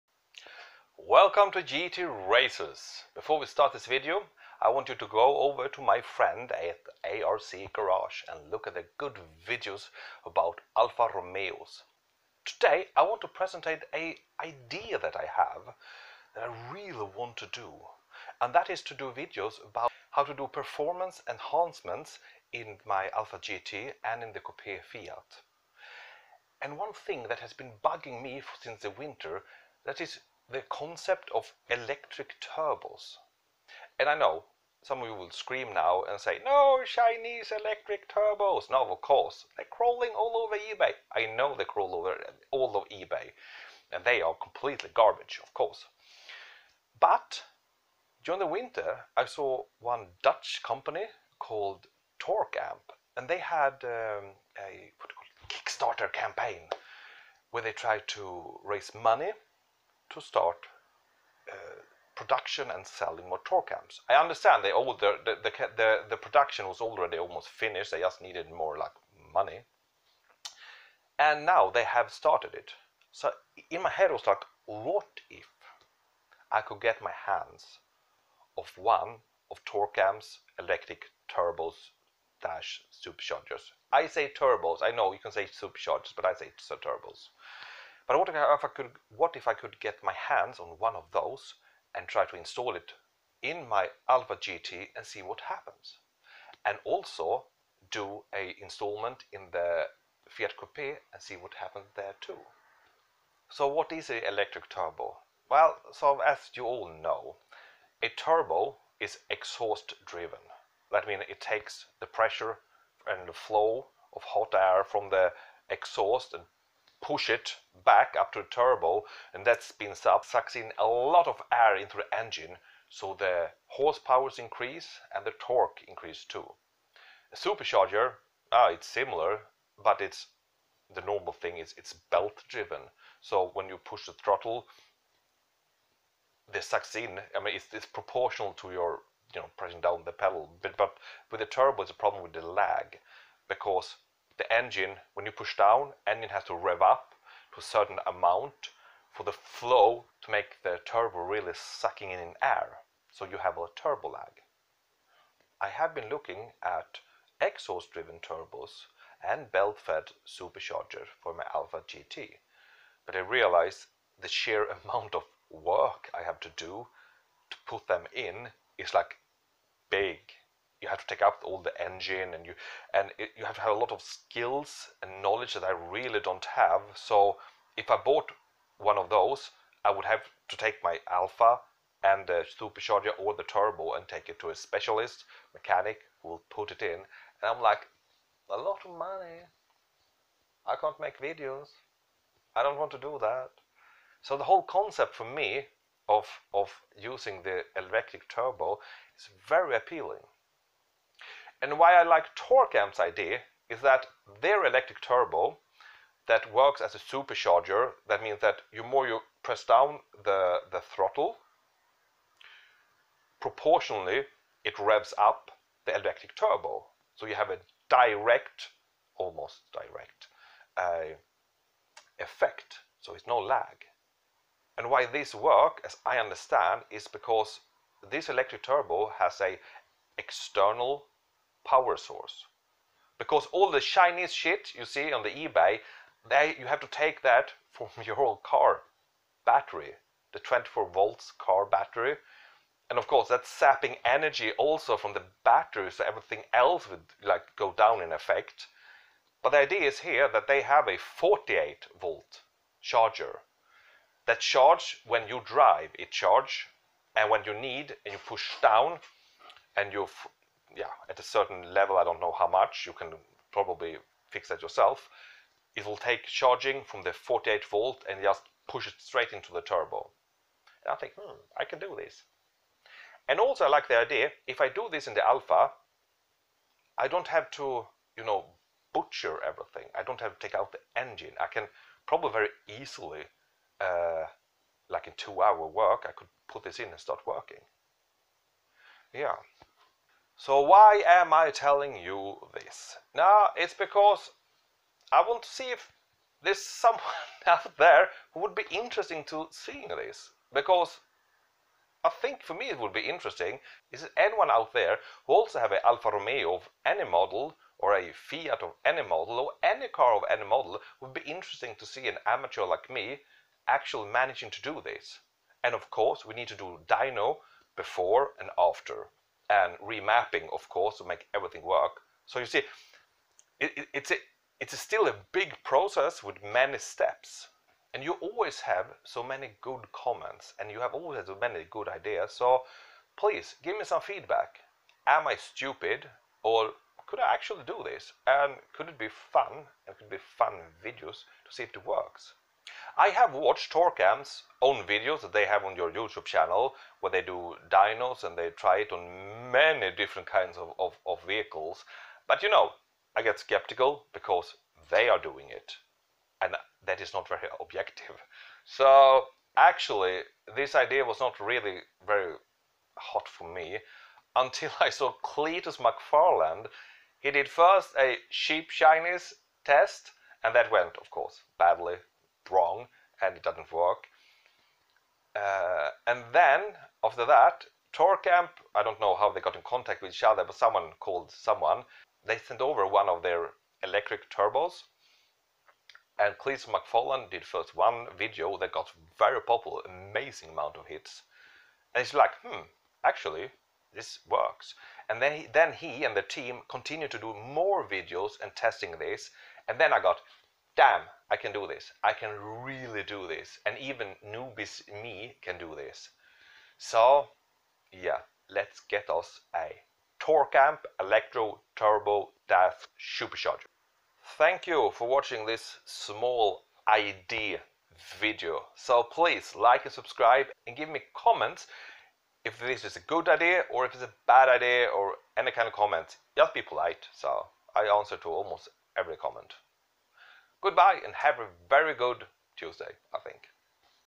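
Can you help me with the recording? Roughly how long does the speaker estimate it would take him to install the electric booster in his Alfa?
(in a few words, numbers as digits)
2 hours.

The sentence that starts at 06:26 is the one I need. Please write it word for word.
And Cleetus McFarland did first one video that got very popular, amazing amount of hits.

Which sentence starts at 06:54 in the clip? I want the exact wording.
Thank you for watching this small idea video.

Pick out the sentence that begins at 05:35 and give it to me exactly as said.
Am I stupid or could I actually do this?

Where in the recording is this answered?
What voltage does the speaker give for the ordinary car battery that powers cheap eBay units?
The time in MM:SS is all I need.
04:00.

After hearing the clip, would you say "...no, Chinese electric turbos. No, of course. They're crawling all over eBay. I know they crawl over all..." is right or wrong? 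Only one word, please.
right.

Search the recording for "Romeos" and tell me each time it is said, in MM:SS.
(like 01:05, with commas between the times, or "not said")
00:11, 05:06.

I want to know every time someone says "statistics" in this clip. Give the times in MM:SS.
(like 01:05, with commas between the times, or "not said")
not said.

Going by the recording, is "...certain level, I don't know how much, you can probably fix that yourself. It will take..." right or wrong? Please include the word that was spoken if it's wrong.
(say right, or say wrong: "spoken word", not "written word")
right.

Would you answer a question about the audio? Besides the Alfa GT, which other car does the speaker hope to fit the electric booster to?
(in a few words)
Fiat Coupe.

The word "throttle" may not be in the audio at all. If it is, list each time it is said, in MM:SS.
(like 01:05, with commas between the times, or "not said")
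02:14, 03:30.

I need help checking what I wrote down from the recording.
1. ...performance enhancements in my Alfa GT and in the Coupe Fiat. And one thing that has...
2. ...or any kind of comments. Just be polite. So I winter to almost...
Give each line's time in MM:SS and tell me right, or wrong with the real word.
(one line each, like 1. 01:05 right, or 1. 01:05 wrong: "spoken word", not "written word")
1. 00:20 right
2. 07:04 wrong: "answer", not "winter".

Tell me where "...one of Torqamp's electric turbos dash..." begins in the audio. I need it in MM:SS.
01:18.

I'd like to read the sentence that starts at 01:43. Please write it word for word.
So what is an electric turbo?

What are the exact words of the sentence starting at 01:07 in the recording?
They just needed more like money.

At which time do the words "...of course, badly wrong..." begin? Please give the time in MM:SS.
06:11.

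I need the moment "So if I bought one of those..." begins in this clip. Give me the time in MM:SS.
02:56.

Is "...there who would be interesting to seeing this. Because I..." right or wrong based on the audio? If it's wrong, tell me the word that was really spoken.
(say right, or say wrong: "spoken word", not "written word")
right.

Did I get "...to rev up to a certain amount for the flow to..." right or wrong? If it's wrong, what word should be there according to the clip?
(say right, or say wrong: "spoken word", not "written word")
right.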